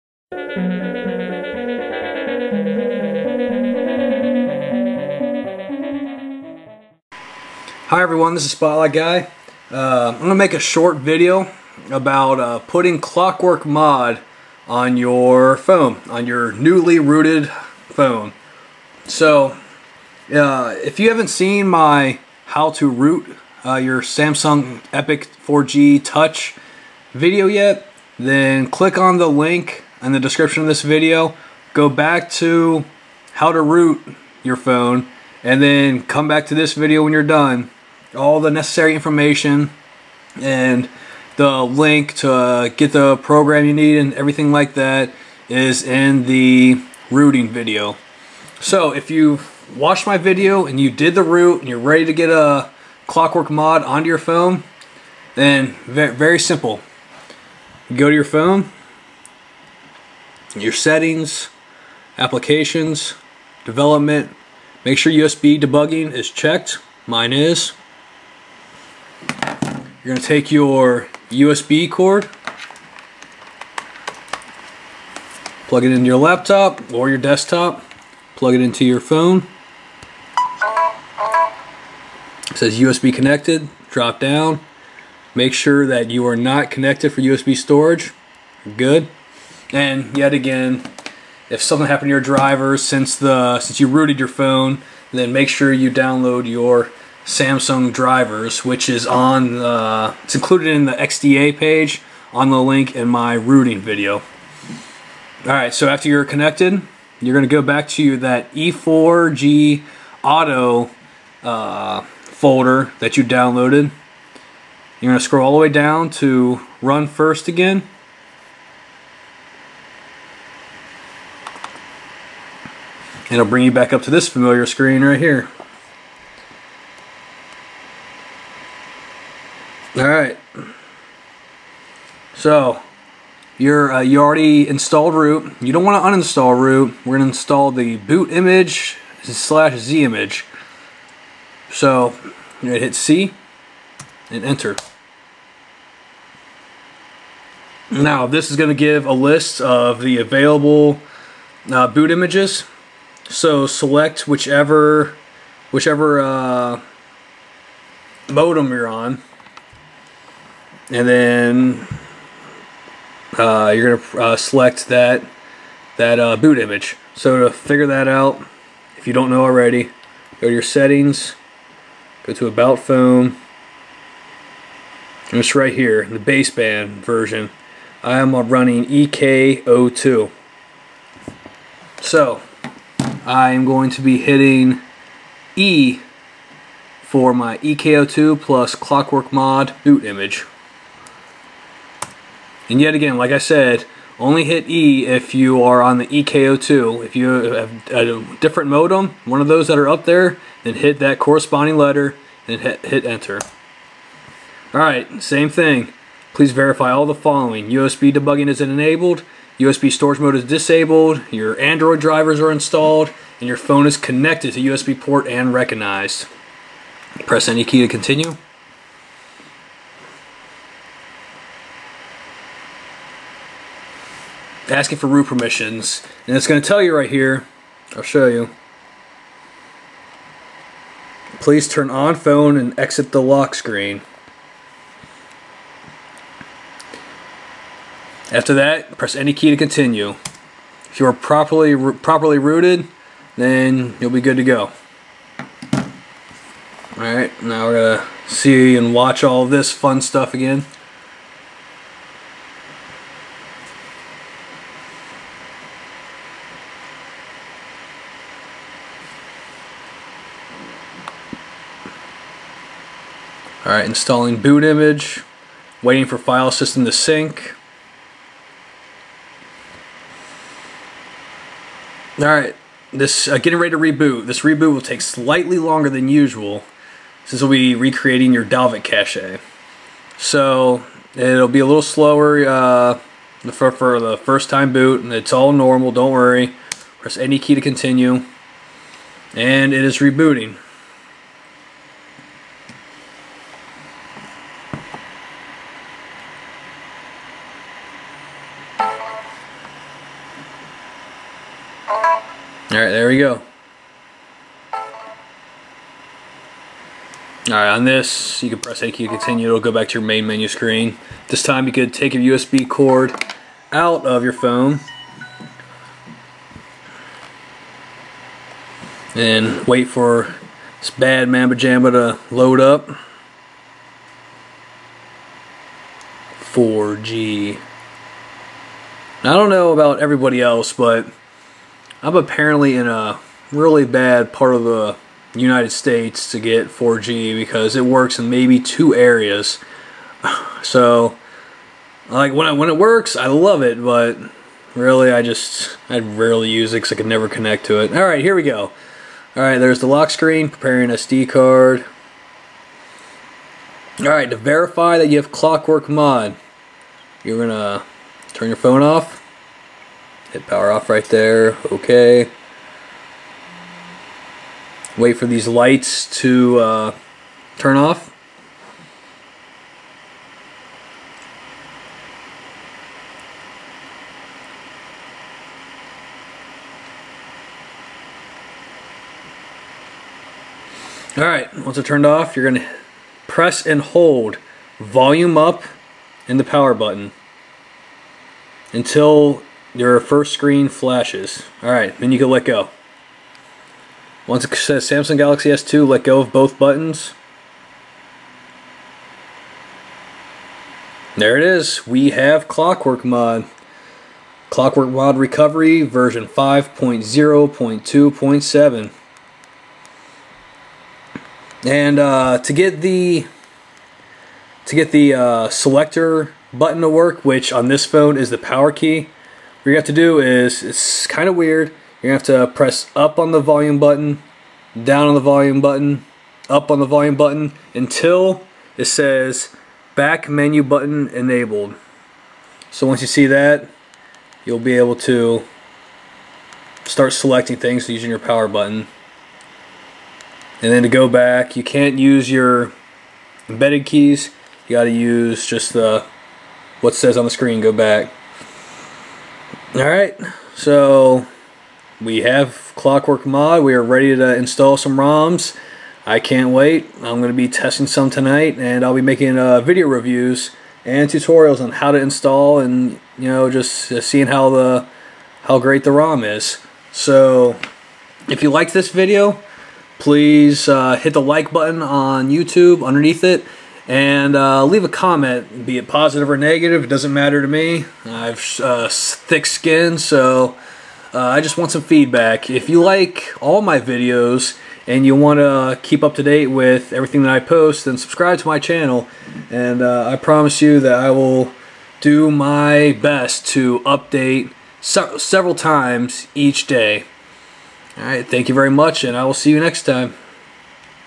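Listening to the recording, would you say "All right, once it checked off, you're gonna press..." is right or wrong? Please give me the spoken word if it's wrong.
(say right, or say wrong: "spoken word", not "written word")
wrong: "turned", not "checked".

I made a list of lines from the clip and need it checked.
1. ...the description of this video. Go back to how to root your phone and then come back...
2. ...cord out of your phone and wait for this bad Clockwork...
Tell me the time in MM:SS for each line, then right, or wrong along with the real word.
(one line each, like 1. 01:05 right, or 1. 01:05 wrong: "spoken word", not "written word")
1. 00:30 right
2. 05:12 wrong: "Mamba", not "Clockwork".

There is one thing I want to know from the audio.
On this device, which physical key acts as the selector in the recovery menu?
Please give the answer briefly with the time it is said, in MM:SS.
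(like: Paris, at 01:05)
power key, at 06:58.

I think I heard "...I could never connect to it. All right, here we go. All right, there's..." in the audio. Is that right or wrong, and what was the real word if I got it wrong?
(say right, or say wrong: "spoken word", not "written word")
right.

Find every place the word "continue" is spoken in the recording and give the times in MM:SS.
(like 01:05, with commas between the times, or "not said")
03:37, 03:59, 04:47, 05:09.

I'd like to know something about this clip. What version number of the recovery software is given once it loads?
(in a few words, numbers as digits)
5.0.2.7.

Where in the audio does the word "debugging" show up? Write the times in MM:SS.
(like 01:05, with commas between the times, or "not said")
01:05, 03:28.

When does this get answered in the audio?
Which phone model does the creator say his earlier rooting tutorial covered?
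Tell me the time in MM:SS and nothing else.
00:24.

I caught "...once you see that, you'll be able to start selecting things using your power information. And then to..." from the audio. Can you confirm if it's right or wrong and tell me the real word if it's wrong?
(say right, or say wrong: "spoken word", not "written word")
wrong: "button", not "information".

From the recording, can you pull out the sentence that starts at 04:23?
Alright, installing boot image, waiting for file system to sync.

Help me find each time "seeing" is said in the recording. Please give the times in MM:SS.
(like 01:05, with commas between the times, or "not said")
07:44.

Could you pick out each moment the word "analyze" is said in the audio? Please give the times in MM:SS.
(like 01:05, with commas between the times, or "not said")
not said.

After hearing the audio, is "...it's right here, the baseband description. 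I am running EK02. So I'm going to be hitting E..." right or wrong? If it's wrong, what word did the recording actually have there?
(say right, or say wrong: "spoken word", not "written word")
wrong: "version", not "description".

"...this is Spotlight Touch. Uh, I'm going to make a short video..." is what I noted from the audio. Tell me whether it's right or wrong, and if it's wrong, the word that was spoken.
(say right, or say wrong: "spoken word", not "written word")
wrong: "Guy", not "Touch".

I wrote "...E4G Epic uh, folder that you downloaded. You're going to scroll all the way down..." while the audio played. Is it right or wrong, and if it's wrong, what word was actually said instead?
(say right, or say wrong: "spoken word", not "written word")
wrong: "Auto", not "Epic".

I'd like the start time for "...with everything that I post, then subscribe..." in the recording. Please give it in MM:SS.
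08:06.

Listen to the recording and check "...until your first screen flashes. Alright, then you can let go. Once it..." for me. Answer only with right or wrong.
right.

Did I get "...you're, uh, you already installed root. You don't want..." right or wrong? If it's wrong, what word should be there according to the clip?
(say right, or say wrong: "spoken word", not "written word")
right.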